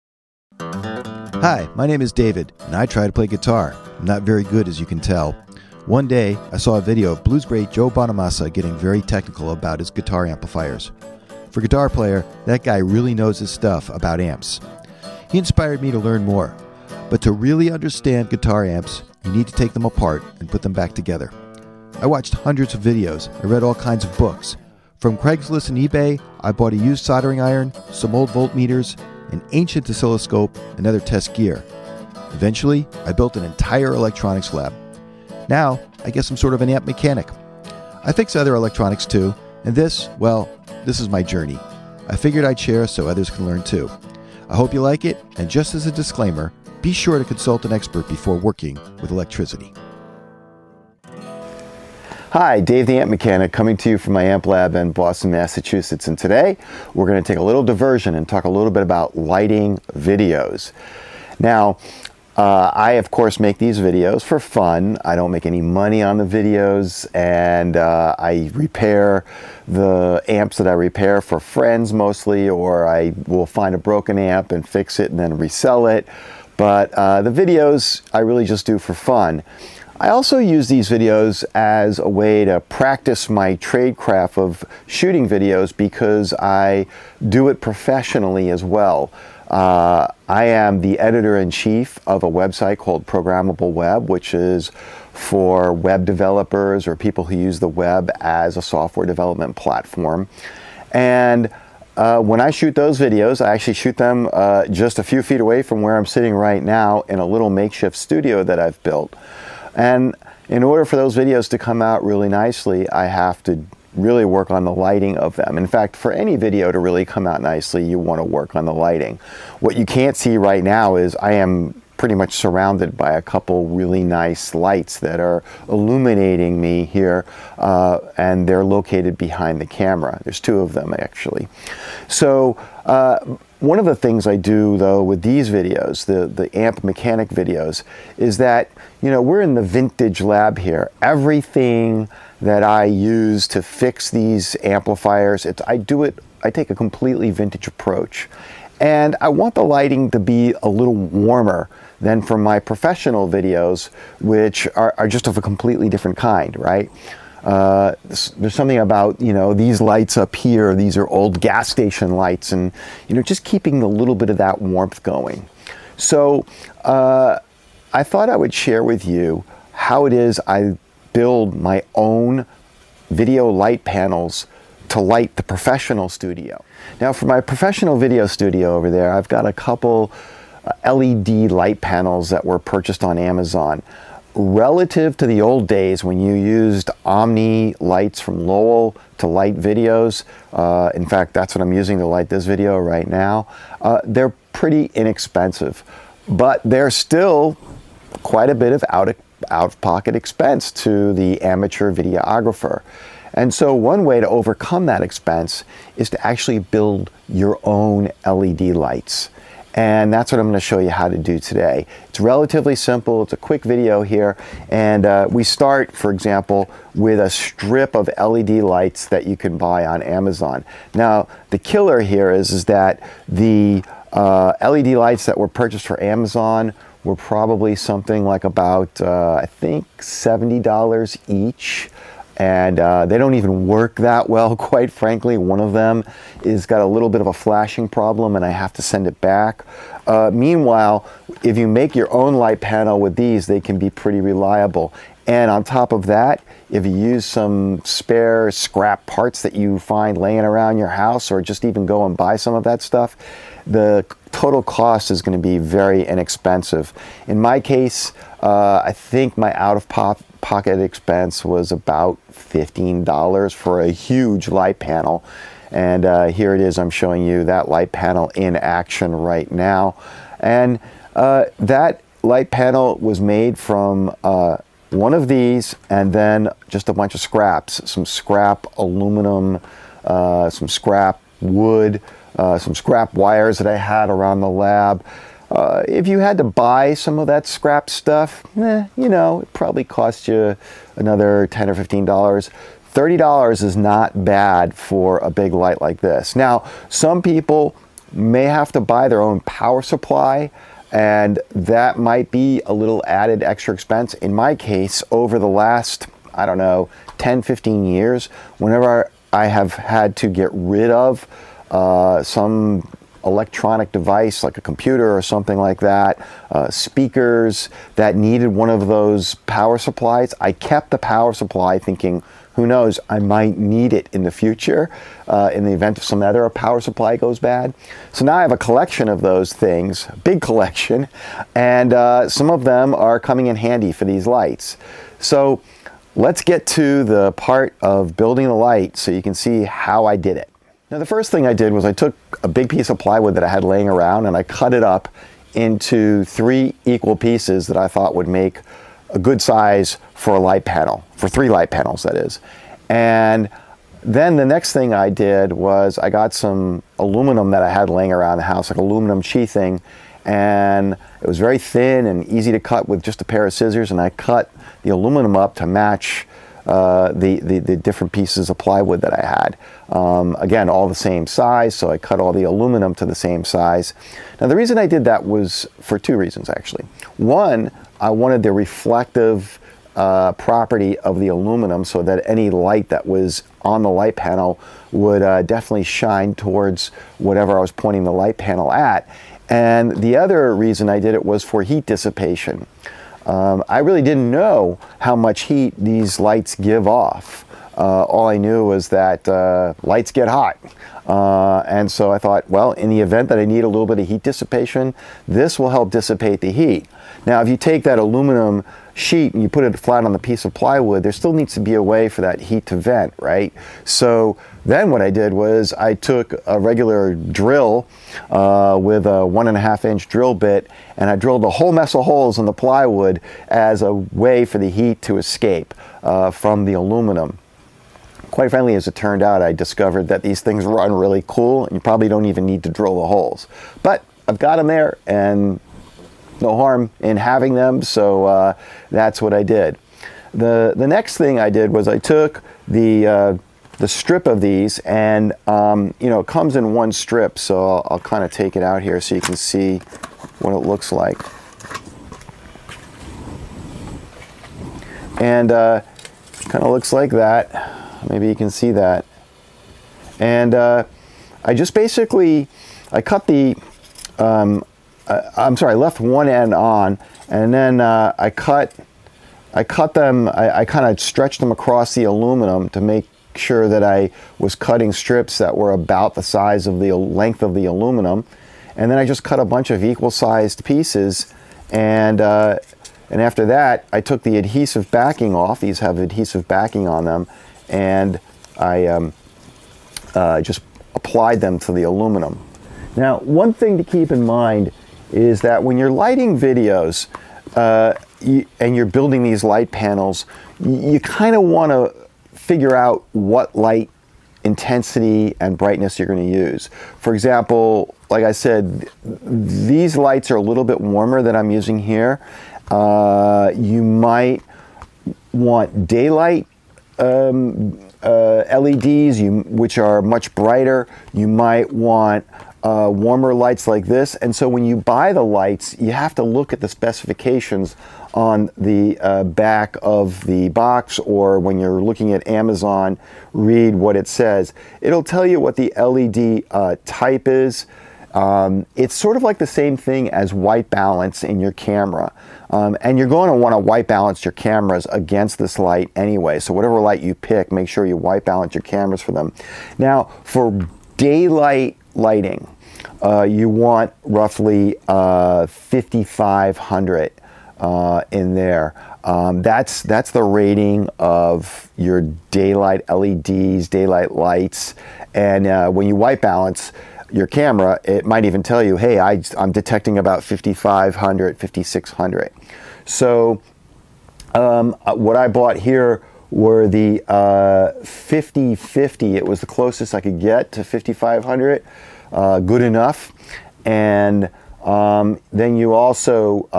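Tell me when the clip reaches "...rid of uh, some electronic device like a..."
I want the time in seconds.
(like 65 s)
310 s.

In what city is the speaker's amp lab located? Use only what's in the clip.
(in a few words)
Boston.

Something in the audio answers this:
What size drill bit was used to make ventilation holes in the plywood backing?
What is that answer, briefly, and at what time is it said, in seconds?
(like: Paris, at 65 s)
1.5 inch, at 419 s.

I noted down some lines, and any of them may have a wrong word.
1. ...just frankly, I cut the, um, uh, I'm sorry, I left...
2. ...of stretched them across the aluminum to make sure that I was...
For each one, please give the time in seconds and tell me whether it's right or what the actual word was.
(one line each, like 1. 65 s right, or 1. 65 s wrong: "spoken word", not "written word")
1. 461 s wrong: "basically", not "frankly"
2. 470 s right.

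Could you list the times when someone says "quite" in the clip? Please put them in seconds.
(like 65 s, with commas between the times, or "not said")
198 s, 234 s, 428 s.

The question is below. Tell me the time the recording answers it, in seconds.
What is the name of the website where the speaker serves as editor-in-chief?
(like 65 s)
93 s.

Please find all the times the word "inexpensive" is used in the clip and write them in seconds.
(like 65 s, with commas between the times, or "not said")
194 s, 256 s.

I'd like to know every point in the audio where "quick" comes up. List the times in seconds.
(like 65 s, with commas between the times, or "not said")
213 s.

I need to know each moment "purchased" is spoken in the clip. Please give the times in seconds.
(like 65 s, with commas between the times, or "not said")
182 s, 225 s.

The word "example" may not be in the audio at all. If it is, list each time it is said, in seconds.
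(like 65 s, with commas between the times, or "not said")
216 s, 507 s.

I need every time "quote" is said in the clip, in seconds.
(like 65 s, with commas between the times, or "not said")
not said.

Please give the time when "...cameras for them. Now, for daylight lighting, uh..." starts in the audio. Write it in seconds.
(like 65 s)
548 s.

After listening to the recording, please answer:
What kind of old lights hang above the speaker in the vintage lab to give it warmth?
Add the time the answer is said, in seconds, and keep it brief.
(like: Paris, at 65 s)
gas station lights, at 161 s.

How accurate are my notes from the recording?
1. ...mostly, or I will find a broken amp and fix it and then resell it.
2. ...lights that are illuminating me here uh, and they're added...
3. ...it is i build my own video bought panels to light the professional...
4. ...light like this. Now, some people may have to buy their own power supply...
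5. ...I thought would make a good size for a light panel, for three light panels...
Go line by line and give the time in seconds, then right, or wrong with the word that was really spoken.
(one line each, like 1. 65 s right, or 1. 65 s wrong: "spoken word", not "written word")
1. 71 s right
2. 124 s wrong: "located", not "added"
3. 170 s wrong: "light", not "bought"
4. 295 s right
5. 347 s right.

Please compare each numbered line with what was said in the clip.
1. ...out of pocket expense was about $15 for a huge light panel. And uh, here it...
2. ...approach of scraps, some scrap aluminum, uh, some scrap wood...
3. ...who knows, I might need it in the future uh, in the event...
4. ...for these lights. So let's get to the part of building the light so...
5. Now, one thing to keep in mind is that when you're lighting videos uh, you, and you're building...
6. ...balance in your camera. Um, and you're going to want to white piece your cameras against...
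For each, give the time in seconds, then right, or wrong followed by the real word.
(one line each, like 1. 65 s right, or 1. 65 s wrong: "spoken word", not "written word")
1. 259 s right
2. 276 s wrong: "bunch", not "approach"
3. 322 s right
4. 333 s right
5. 492 s right
6. 540 s wrong: "balance", not "piece".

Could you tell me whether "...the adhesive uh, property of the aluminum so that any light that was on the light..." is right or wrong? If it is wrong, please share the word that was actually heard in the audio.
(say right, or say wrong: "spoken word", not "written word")
wrong: "reflective", not "adhesive".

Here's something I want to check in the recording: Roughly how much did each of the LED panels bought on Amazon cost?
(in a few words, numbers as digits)
$70.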